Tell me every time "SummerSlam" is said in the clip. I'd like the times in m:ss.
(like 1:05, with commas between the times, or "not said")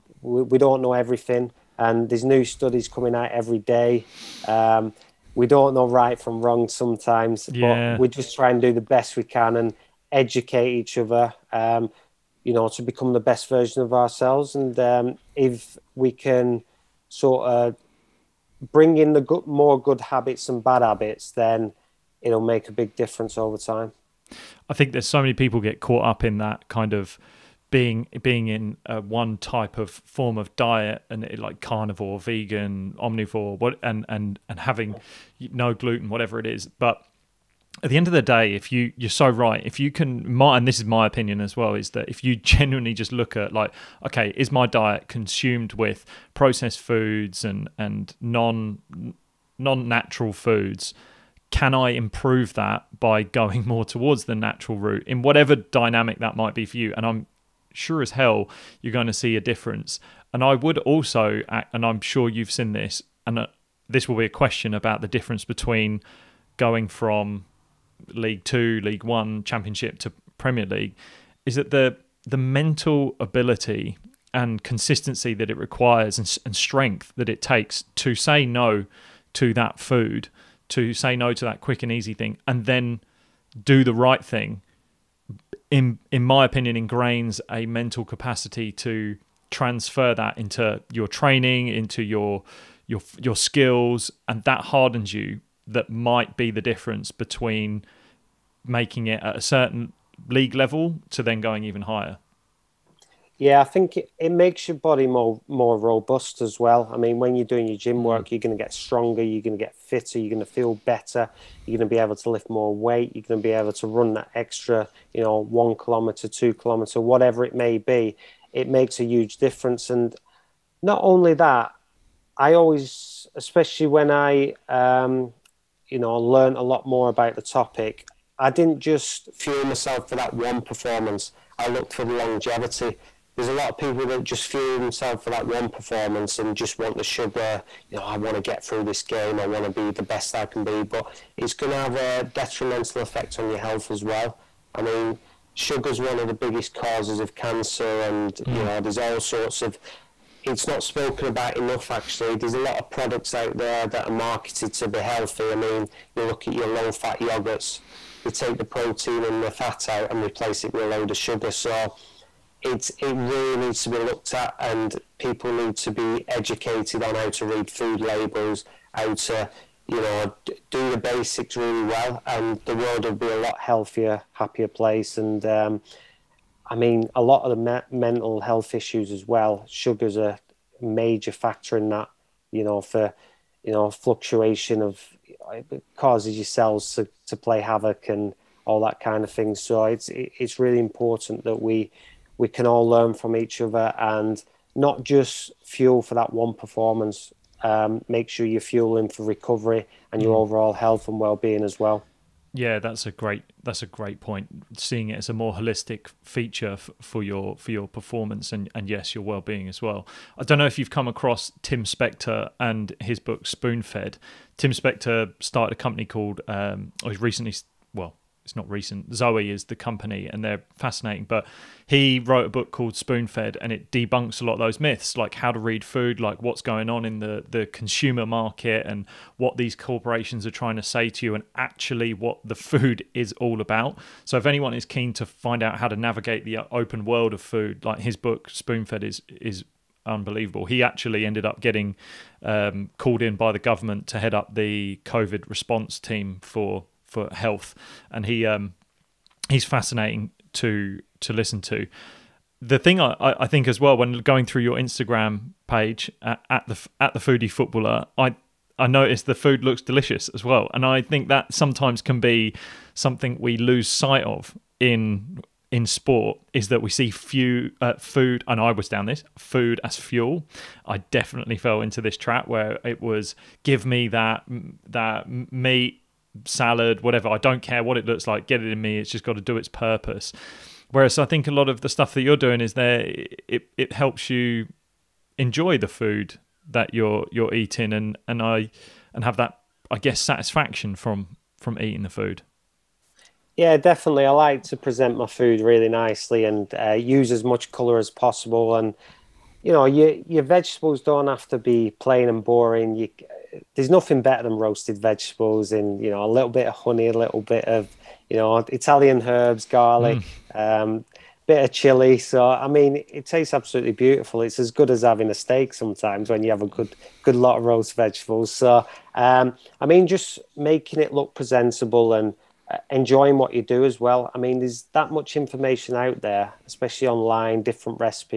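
not said.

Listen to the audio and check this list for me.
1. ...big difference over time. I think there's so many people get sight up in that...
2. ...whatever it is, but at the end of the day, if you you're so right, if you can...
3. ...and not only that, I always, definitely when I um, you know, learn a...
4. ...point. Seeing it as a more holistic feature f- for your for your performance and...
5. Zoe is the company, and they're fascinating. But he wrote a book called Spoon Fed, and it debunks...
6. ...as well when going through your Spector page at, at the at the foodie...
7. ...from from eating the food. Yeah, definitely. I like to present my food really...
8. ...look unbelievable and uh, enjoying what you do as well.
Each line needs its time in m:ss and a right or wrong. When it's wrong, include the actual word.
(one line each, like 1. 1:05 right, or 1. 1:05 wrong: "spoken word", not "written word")
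1. 0:22 wrong: "caught", not "sight"
2. 0:36 right
3. 1:59 wrong: "especially", not "definitely"
4. 3:24 right
5. 3:39 right
6. 4:13 wrong: "Instagram", not "Spector"
7. 4:50 right
8. 5:21 wrong: "presentable", not "unbelievable".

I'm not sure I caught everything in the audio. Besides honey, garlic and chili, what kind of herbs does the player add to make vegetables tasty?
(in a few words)
Italian herbs.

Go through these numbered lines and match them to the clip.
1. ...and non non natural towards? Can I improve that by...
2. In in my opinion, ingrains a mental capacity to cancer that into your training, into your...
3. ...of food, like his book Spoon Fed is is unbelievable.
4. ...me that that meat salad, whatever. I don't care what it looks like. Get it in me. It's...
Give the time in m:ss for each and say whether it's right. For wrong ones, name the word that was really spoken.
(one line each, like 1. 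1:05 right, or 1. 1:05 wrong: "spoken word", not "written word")
1. 0:47 wrong: "foods", not "towards"
2. 1:25 wrong: "transfer", not "cancer"
3. 3:57 right
4. 4:33 right.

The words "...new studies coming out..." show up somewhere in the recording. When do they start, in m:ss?
0:02.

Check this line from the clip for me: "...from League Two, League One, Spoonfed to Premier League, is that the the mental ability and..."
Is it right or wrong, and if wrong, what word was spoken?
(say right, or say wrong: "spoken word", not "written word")
wrong: "Championship", not "Spoonfed".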